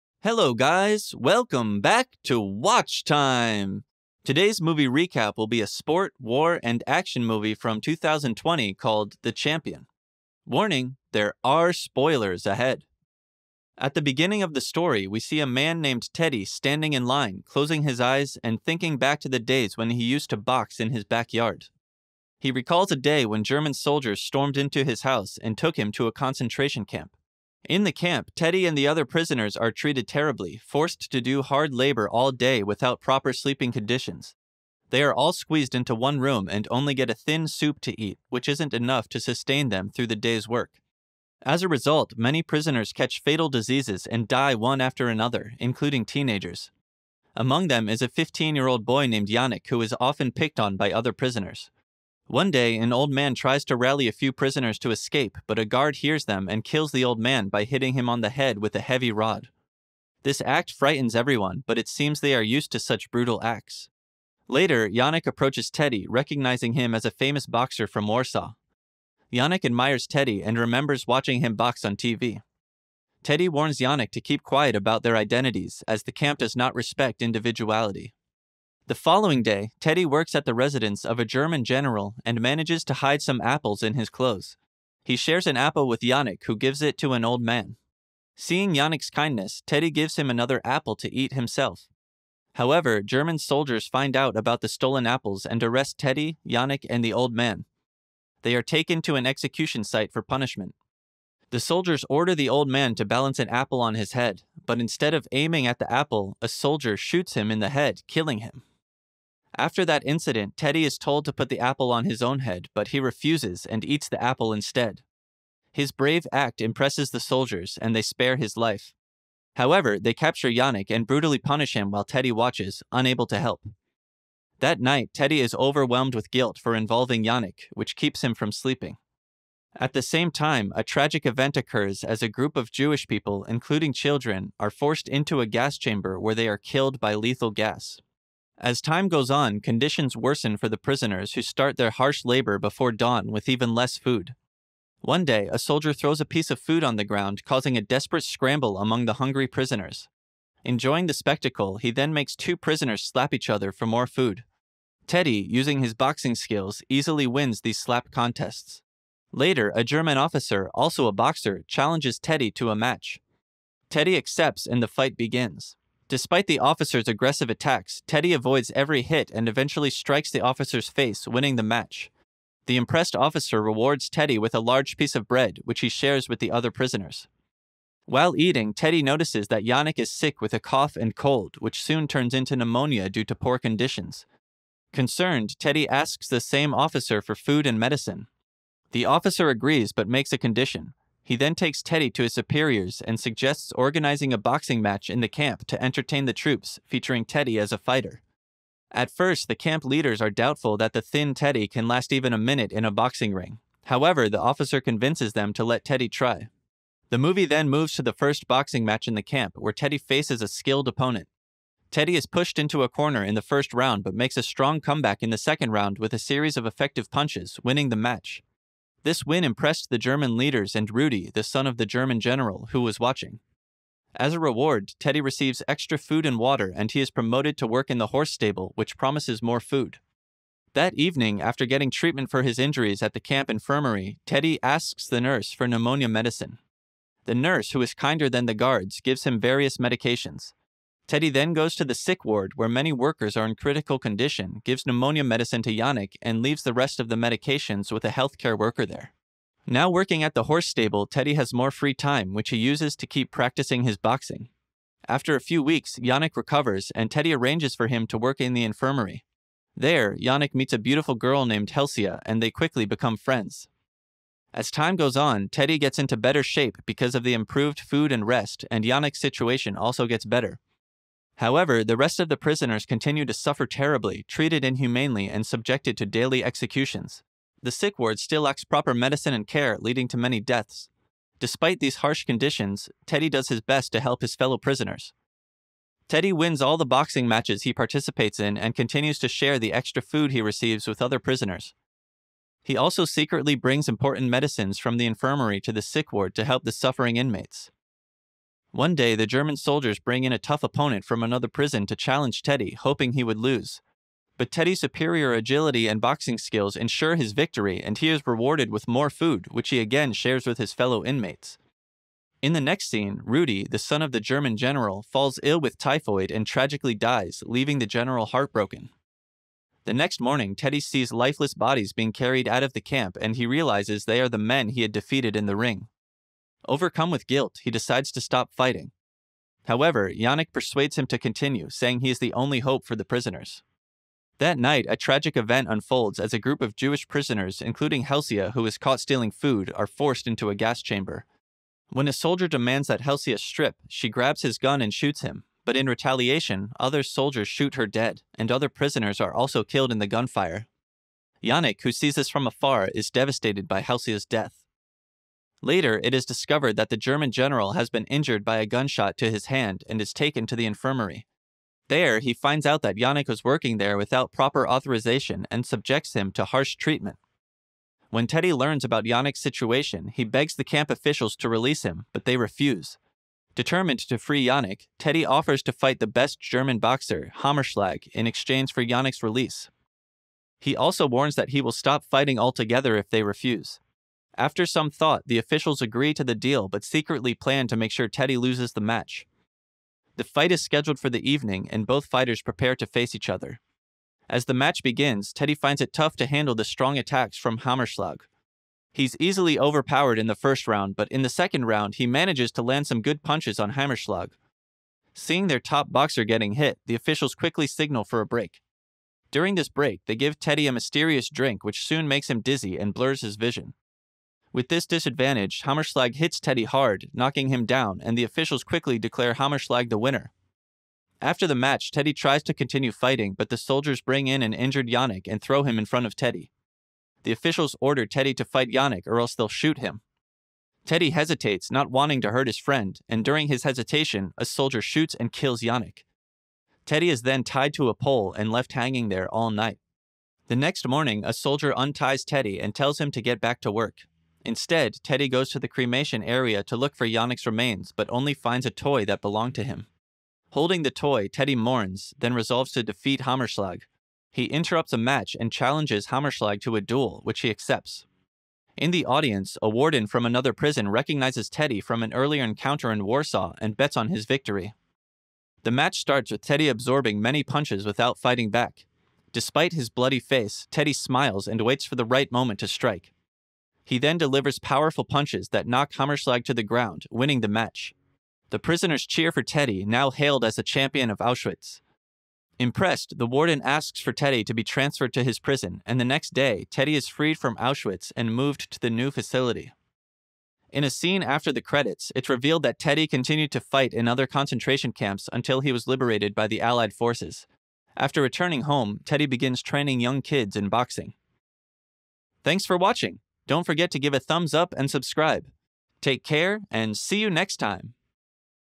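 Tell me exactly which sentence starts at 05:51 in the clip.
Yannick, who sees this from afar, is devastated by Helsia's death.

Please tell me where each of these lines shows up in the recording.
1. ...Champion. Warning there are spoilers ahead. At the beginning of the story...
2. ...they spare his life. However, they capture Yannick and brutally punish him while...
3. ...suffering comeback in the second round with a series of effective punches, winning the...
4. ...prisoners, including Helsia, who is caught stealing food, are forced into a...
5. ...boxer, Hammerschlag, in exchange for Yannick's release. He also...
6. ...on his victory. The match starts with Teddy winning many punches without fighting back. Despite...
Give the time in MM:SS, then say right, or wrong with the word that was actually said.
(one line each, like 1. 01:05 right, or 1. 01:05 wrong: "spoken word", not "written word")
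1. 00:09 right
2. 01:57 right
3. 03:34 wrong: "strong", not "suffering"
4. 05:37 right
5. 06:16 right
6. 07:43 wrong: "absorbing", not "winning".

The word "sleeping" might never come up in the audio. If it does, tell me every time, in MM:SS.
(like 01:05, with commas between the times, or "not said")
00:33, 02:08.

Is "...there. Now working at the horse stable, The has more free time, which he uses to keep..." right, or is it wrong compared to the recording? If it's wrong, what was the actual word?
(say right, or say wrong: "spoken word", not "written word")
wrong: "Teddy", not "The".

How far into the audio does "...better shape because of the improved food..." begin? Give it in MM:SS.
04:26.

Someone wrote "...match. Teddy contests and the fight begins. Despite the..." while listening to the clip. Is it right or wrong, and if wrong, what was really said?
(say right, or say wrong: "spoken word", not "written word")
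wrong: "accepts", not "contests".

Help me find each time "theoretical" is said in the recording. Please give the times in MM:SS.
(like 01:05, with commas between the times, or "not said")
not said.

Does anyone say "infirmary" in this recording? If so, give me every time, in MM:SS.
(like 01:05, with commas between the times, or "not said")
03:53, 04:18, 04:55, 06:00.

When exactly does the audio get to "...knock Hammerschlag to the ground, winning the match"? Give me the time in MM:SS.
07:55.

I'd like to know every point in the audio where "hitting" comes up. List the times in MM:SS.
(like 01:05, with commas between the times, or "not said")
00:57.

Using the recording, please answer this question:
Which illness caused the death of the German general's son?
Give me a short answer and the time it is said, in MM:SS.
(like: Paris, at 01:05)
Typhoid, at 05:15.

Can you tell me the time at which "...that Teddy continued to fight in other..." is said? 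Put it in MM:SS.
08:12.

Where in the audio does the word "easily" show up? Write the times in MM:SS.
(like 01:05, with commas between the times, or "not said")
02:36, 06:39.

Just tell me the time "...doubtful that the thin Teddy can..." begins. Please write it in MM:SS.
03:20.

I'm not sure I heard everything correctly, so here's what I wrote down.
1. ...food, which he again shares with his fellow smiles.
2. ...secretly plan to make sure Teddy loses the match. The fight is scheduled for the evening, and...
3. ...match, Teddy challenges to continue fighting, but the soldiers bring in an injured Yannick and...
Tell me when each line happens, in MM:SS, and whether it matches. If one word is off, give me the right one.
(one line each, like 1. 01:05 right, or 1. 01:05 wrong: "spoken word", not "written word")
1. 05:09 wrong: "inmates", not "smiles"
2. 06:26 right
3. 07:01 wrong: "tries", not "challenges".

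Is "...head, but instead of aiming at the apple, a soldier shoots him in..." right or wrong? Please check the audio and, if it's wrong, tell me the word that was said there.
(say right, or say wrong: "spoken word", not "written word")
right.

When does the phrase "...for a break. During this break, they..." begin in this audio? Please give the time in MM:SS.
06:48.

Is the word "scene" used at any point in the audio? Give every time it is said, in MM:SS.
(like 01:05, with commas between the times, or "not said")
05:12, 08:10.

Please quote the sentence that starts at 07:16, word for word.
Teddy is then tied to a pole and left hanging there all night.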